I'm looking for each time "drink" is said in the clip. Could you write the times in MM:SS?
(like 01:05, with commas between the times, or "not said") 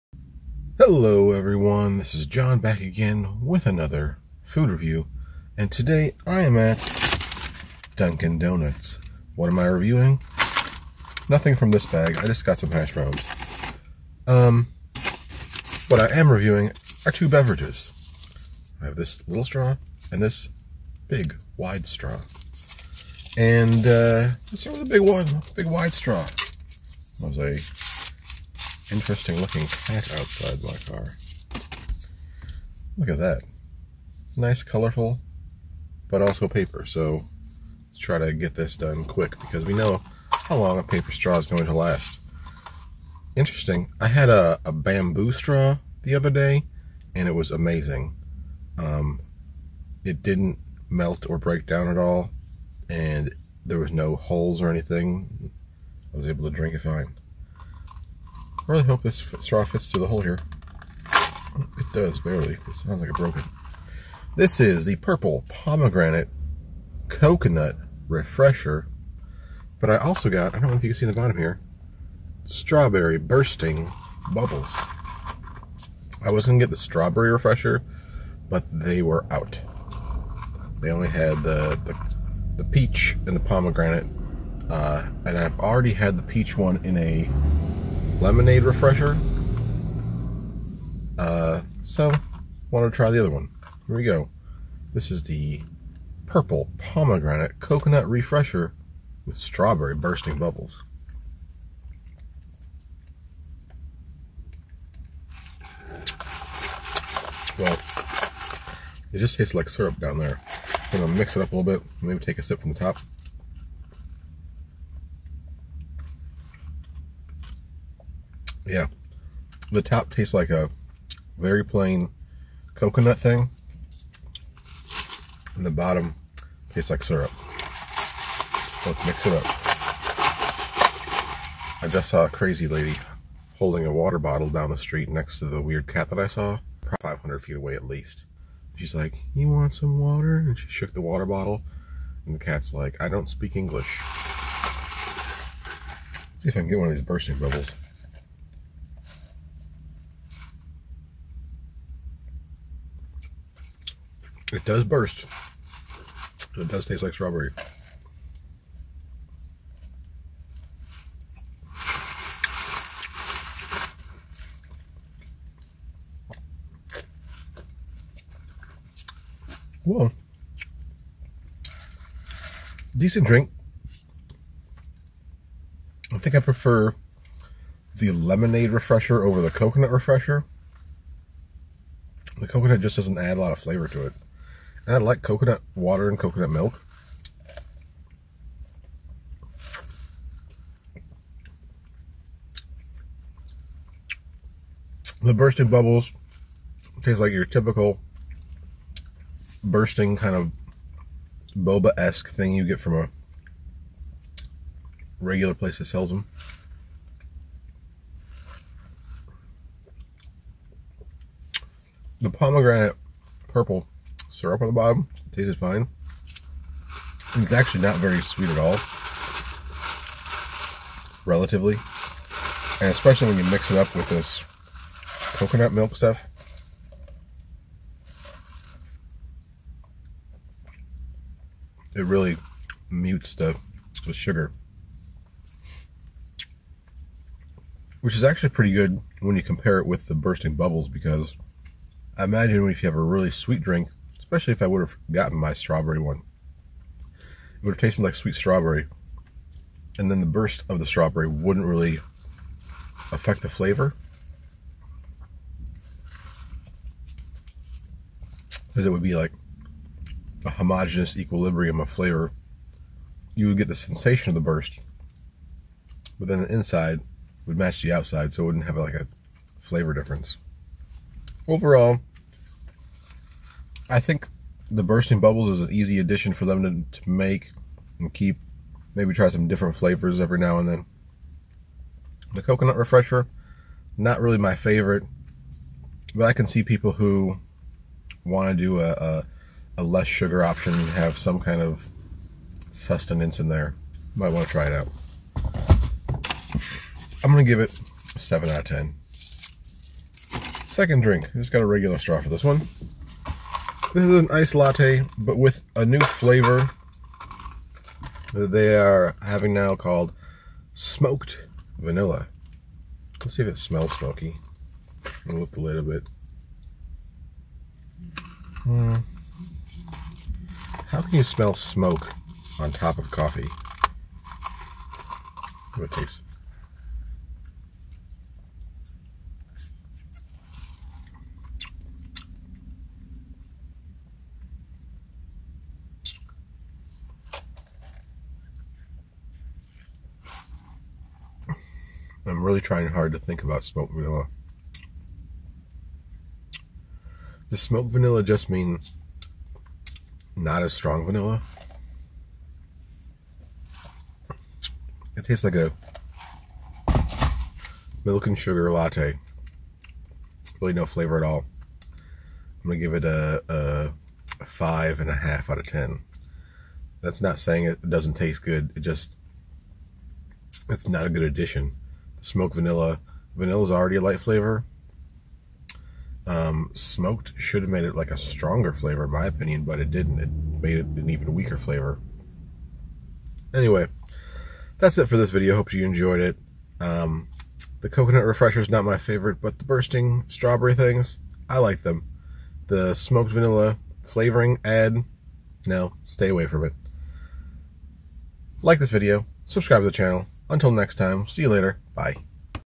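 00:56, 02:53, 04:03, 05:01.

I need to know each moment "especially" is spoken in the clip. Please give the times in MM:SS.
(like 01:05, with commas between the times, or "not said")
03:42, 04:04.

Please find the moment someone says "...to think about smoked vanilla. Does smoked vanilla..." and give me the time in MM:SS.
05:43.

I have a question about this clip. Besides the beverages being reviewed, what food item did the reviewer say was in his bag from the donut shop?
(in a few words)
hash browns.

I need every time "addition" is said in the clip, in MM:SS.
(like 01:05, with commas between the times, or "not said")
04:35, 06:11.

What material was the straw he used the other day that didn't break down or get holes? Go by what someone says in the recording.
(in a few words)
bamboo.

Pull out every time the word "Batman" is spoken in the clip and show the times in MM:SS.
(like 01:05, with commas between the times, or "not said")
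not said.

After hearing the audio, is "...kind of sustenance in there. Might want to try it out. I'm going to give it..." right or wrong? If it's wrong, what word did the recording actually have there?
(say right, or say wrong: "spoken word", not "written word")
right.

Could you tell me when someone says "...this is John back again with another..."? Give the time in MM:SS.
00:01.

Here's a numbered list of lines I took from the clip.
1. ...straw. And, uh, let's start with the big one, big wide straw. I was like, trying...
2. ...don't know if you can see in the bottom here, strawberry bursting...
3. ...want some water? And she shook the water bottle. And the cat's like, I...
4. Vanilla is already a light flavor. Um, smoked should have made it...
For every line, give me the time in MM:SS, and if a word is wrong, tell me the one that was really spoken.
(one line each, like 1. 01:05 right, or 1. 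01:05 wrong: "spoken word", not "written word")
1. 00:21 wrong: "interesting", not "trying"
2. 01:10 right
3. 02:19 right
4. 06:13 right.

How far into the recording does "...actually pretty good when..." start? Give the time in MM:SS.
03:58.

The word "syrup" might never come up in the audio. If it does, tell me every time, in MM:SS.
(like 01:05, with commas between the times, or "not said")
01:49, 02:07, 03:34.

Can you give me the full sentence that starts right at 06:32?
The smoked vanilla flavoring add, no, stay away from it.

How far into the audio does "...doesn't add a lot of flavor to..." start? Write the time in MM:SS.
03:02.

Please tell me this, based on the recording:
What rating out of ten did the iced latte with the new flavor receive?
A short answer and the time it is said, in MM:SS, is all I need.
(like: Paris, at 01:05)
5.5, at 06:04.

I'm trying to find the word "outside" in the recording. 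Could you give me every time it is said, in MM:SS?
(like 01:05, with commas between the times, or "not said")
00:30, 04:27.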